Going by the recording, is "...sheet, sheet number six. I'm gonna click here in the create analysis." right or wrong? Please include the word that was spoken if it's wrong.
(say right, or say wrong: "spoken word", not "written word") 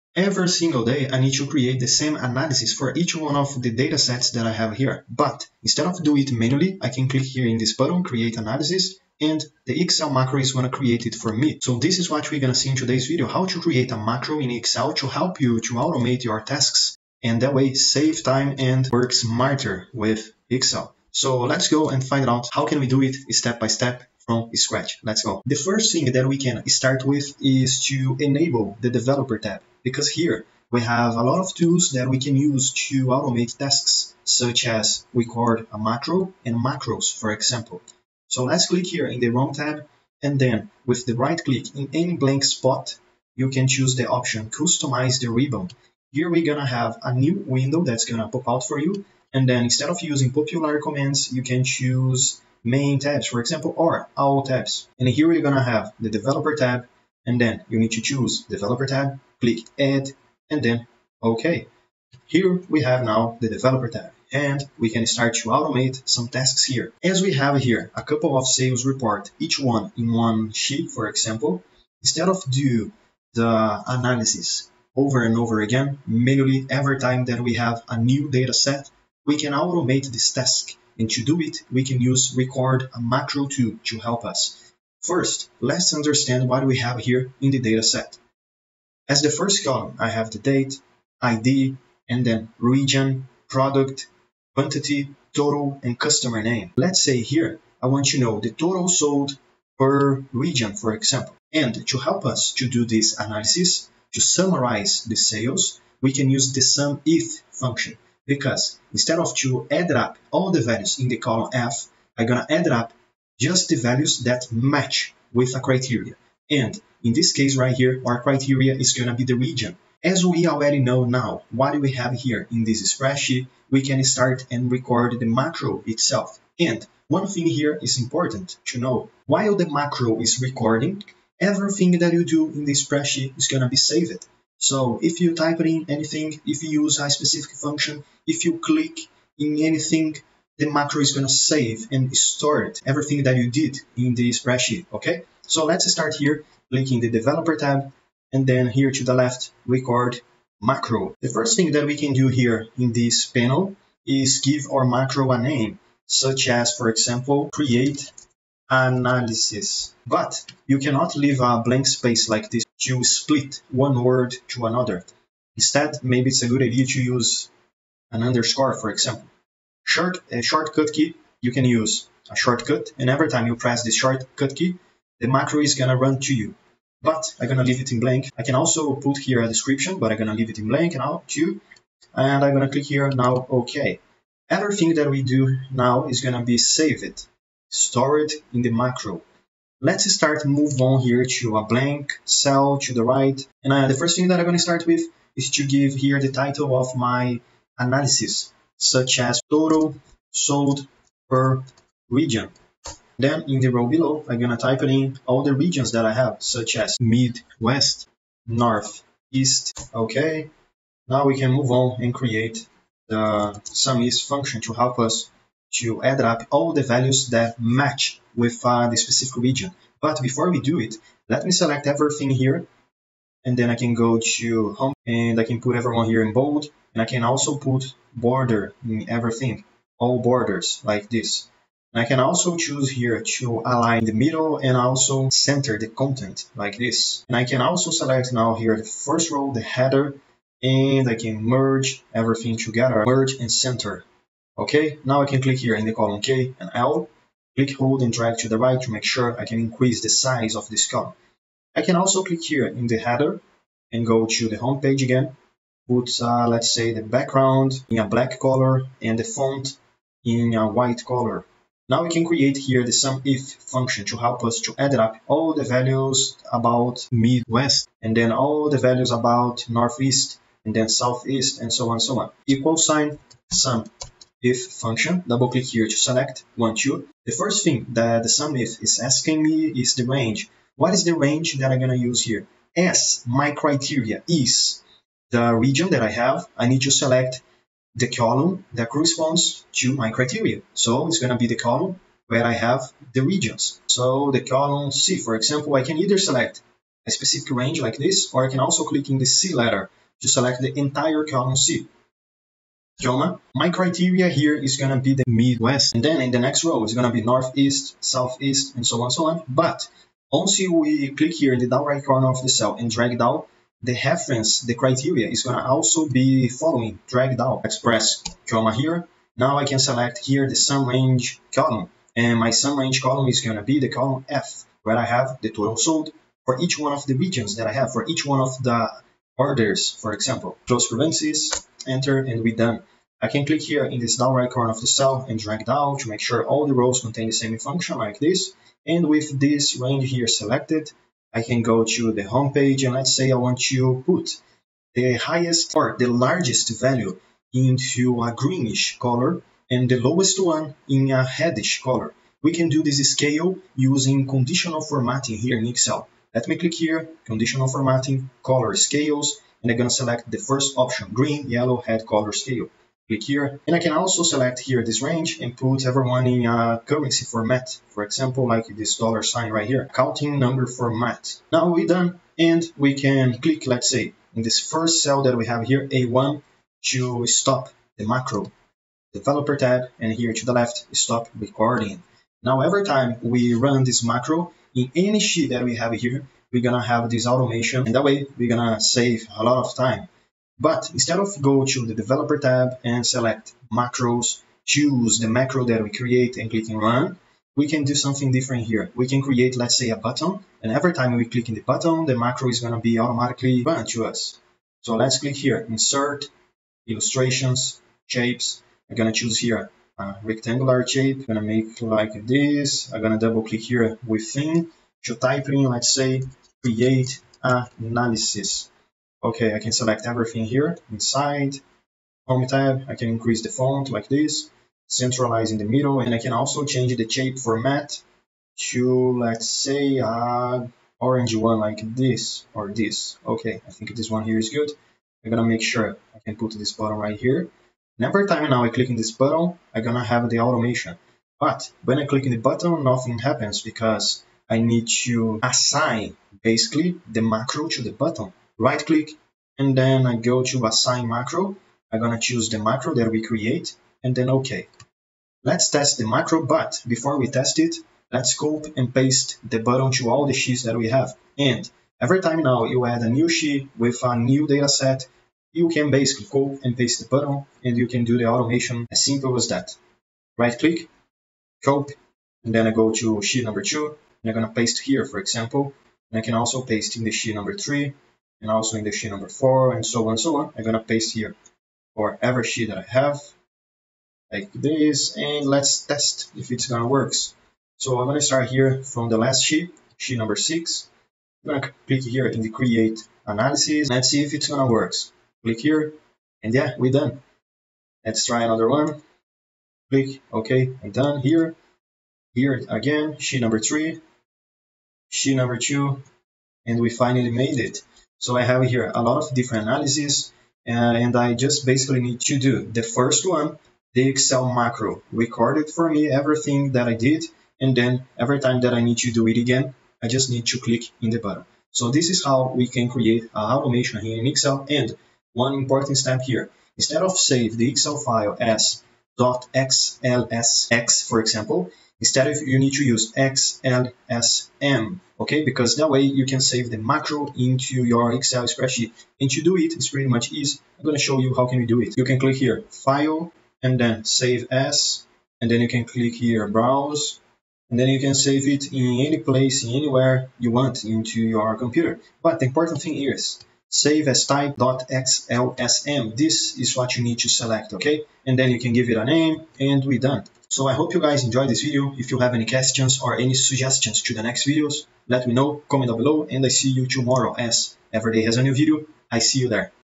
right.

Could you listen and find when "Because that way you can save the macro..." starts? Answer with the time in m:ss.
8:55.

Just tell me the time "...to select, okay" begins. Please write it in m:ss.
9:17.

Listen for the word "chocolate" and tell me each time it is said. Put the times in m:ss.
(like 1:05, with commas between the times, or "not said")
not said.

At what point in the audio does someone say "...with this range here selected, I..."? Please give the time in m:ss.
5:39.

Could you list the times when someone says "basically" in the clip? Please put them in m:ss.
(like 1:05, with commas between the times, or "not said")
7:26, 7:45, 8:31.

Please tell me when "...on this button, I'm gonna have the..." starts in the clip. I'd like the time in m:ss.
7:18.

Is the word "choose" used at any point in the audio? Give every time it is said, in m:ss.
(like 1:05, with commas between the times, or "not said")
0:43, 0:51, 0:58, 3:52, 6:34, 6:49, 7:32.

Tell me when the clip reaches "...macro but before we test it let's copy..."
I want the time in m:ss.
7:36.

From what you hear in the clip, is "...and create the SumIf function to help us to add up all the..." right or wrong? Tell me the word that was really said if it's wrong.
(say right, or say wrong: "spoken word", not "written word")
right.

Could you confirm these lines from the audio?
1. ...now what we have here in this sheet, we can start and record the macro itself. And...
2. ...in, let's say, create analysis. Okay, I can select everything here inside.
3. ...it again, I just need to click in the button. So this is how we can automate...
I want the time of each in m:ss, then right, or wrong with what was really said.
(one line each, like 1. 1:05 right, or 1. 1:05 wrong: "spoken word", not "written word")
1. 2:01 wrong: "spreadsheet", not "sheet"
2. 6:55 right
3. 8:39 wrong: "create", not "automate".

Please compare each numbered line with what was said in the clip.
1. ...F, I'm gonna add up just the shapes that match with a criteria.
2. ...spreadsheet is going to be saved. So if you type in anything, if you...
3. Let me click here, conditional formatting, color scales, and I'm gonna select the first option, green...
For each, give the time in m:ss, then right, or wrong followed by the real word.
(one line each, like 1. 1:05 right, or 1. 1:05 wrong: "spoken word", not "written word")
1. 1:51 wrong: "values", not "shapes"
2. 2:12 right
3. 5:56 right.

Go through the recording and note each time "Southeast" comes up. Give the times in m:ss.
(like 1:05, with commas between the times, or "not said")
4:30, 5:07.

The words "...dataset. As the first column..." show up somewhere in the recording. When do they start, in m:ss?
1:27.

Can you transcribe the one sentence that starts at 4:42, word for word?
S, my criteria is the region that I have.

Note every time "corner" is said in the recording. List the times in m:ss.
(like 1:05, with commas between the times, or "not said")
5:12, 5:34.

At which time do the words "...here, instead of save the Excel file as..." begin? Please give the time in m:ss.
8:46.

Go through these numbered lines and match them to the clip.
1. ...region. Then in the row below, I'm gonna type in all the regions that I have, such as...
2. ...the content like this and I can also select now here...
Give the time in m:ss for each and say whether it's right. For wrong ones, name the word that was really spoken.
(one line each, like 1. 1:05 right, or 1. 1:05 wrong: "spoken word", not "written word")
1. 3:22 right
2. 3:55 right.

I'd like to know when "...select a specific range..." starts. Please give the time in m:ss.
4:56.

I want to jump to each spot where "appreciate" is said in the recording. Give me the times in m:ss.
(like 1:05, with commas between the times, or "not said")
not said.